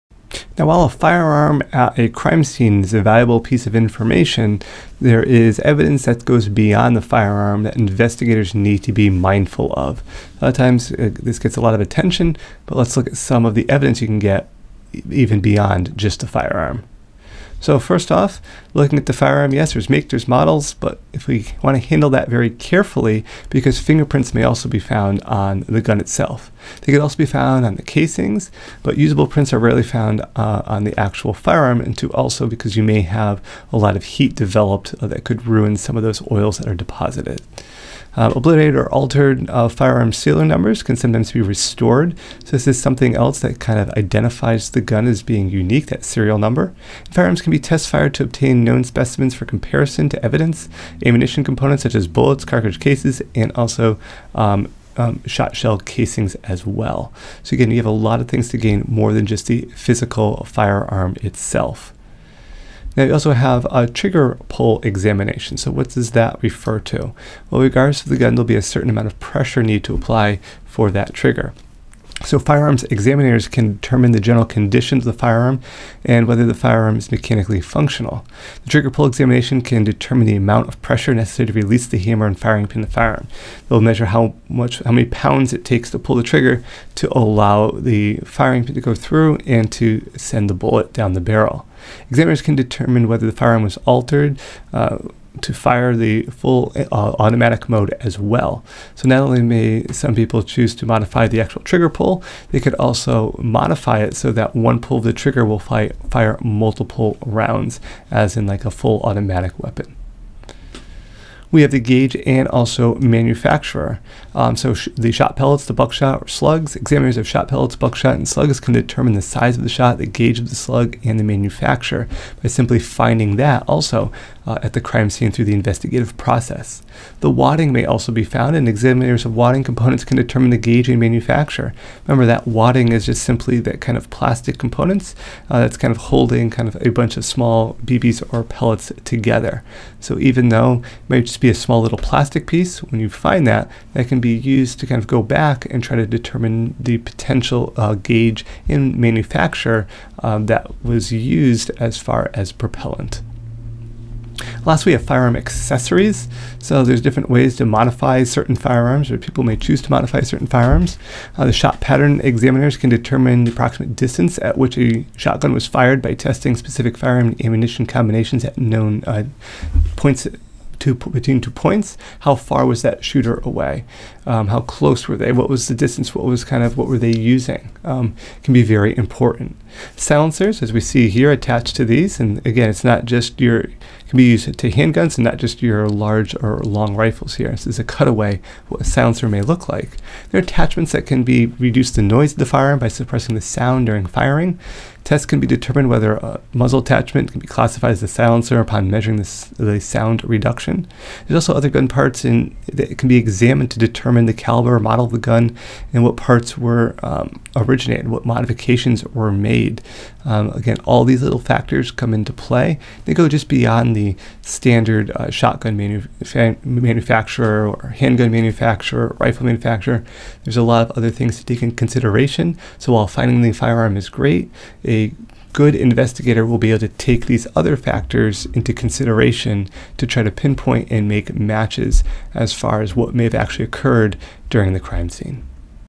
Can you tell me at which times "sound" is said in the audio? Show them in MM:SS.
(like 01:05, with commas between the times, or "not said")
03:13, 03:19.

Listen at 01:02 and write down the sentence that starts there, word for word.
Now we also have a trigger pull examination.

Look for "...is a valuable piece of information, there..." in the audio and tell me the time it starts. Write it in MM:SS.
00:02.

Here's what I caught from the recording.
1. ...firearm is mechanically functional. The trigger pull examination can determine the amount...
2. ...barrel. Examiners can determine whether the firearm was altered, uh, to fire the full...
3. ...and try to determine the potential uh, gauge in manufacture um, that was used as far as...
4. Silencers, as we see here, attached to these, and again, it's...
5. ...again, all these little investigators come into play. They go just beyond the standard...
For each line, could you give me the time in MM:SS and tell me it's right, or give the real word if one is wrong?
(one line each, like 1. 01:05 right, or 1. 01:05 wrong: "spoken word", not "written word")
1. 01:16 right
2. 01:31 right
3. 02:25 right
4. 02:59 right
5. 03:30 wrong: "factors", not "investigators".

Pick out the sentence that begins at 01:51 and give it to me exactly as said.
We have the gauge and also manufacturer.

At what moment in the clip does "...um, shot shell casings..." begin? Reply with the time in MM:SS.
00:54.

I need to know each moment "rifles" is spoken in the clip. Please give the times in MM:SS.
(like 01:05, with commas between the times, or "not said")
03:06, 03:39.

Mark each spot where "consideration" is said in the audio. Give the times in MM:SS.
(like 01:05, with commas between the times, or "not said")
03:41, 03:48.